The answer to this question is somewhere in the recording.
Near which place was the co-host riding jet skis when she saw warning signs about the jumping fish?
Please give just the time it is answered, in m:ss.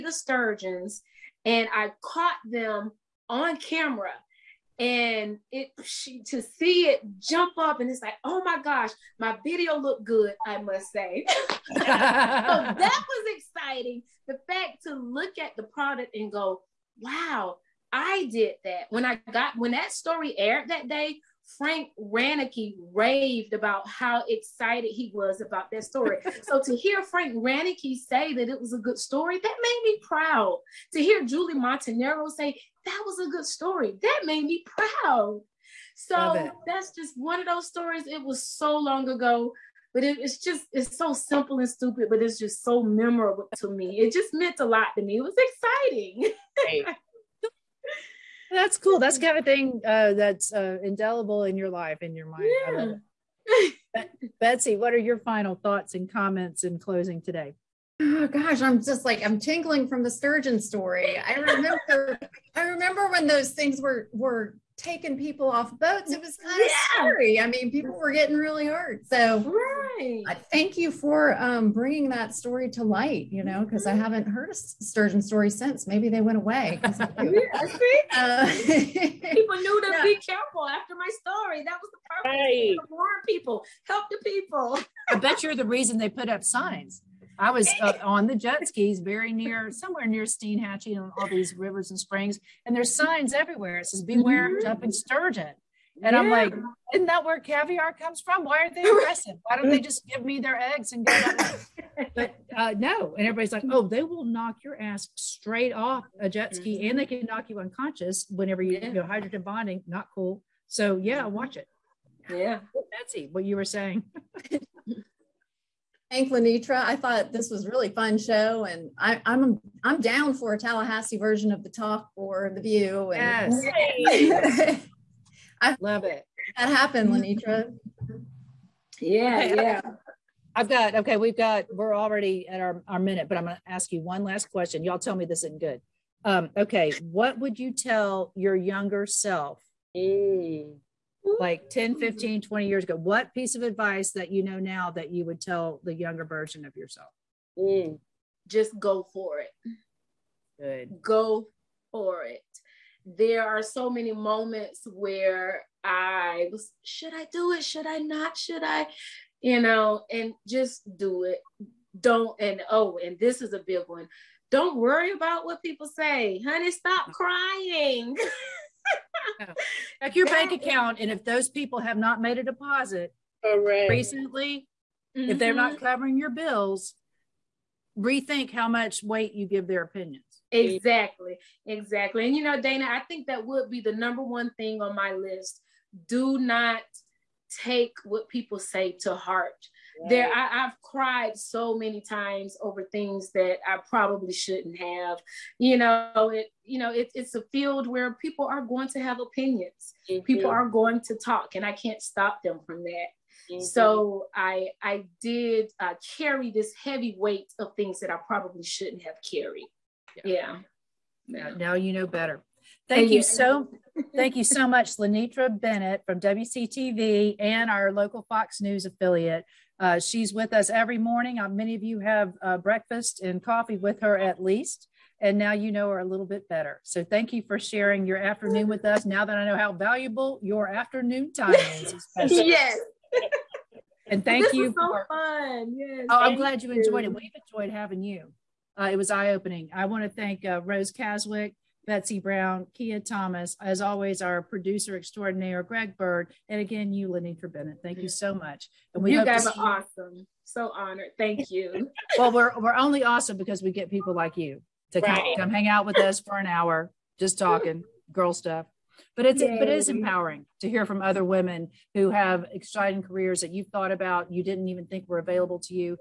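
1:30.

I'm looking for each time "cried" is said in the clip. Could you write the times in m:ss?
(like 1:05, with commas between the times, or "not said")
3:10.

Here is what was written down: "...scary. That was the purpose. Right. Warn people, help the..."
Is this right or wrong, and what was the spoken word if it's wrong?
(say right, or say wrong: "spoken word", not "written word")
wrong: "story", not "scary".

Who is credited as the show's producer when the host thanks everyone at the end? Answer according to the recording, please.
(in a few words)
Greg Bird.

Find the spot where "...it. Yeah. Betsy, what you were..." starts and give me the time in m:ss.
1:51.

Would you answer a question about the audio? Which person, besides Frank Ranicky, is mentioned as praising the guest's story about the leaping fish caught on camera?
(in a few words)
Julie Montanaro.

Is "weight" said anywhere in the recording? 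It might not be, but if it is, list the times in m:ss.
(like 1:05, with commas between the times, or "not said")
2:59, 3:27.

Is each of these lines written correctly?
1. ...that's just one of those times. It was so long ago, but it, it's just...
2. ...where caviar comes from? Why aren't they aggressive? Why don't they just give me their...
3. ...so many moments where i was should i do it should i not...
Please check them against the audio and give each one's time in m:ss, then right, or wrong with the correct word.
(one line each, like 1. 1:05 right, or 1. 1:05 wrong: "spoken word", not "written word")
1. 0:36 wrong: "stories", not "times"
2. 1:37 right
3. 2:33 right.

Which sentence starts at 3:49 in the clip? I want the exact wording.
Now that I know how valuable your afternoon time is, especially.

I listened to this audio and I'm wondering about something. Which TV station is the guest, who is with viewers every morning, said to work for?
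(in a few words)
WCTV.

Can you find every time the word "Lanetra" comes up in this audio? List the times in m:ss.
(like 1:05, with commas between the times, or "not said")
1:56, 2:07, 3:34, 4:07.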